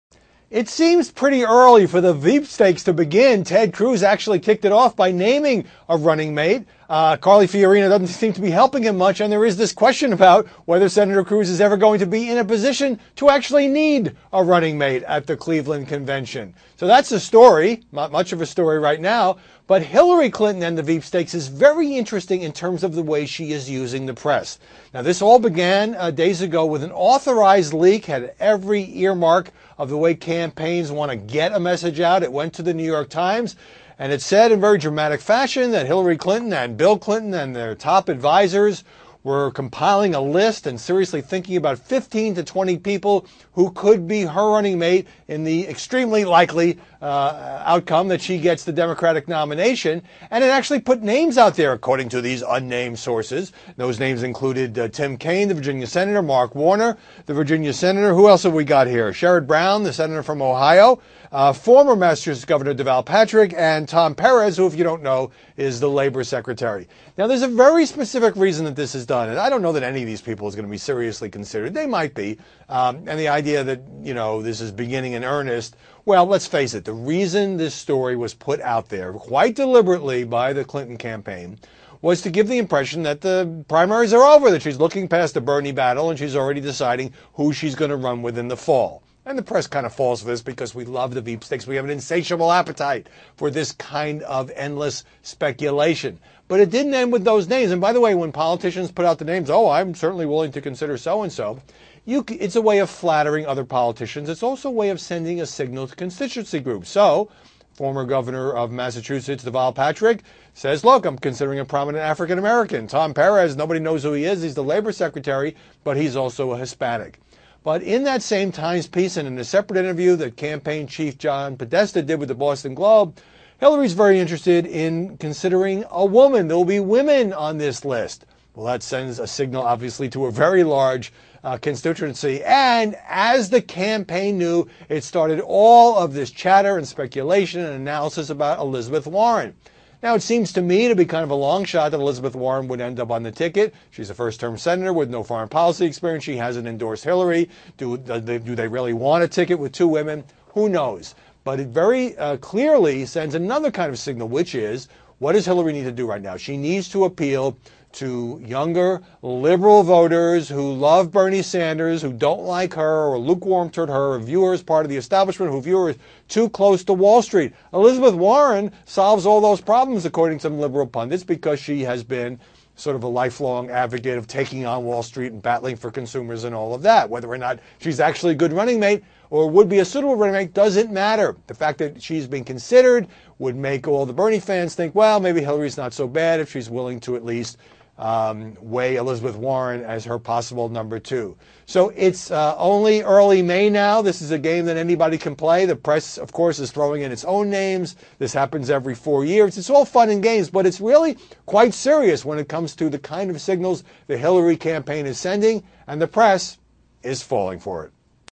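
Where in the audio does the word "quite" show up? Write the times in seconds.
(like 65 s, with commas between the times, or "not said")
79 s, 201 s.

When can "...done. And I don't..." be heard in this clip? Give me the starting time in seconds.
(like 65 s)
69 s.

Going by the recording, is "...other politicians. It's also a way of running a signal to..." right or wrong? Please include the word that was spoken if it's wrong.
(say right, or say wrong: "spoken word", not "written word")
wrong: "sending", not "running".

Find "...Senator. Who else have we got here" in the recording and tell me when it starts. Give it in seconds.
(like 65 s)
57 s.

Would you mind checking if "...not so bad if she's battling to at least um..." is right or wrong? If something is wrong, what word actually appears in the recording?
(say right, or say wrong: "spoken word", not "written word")
wrong: "willing", not "battling".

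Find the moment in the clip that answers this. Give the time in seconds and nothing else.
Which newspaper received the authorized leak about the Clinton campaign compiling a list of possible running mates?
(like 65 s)
32 s.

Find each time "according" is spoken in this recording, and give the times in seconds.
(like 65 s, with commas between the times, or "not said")
51 s, 170 s.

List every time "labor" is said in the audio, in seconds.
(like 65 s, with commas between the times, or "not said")
65 s, 114 s.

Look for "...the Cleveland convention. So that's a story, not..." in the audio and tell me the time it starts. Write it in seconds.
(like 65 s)
15 s.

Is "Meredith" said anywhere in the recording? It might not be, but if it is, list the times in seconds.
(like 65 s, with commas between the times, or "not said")
not said.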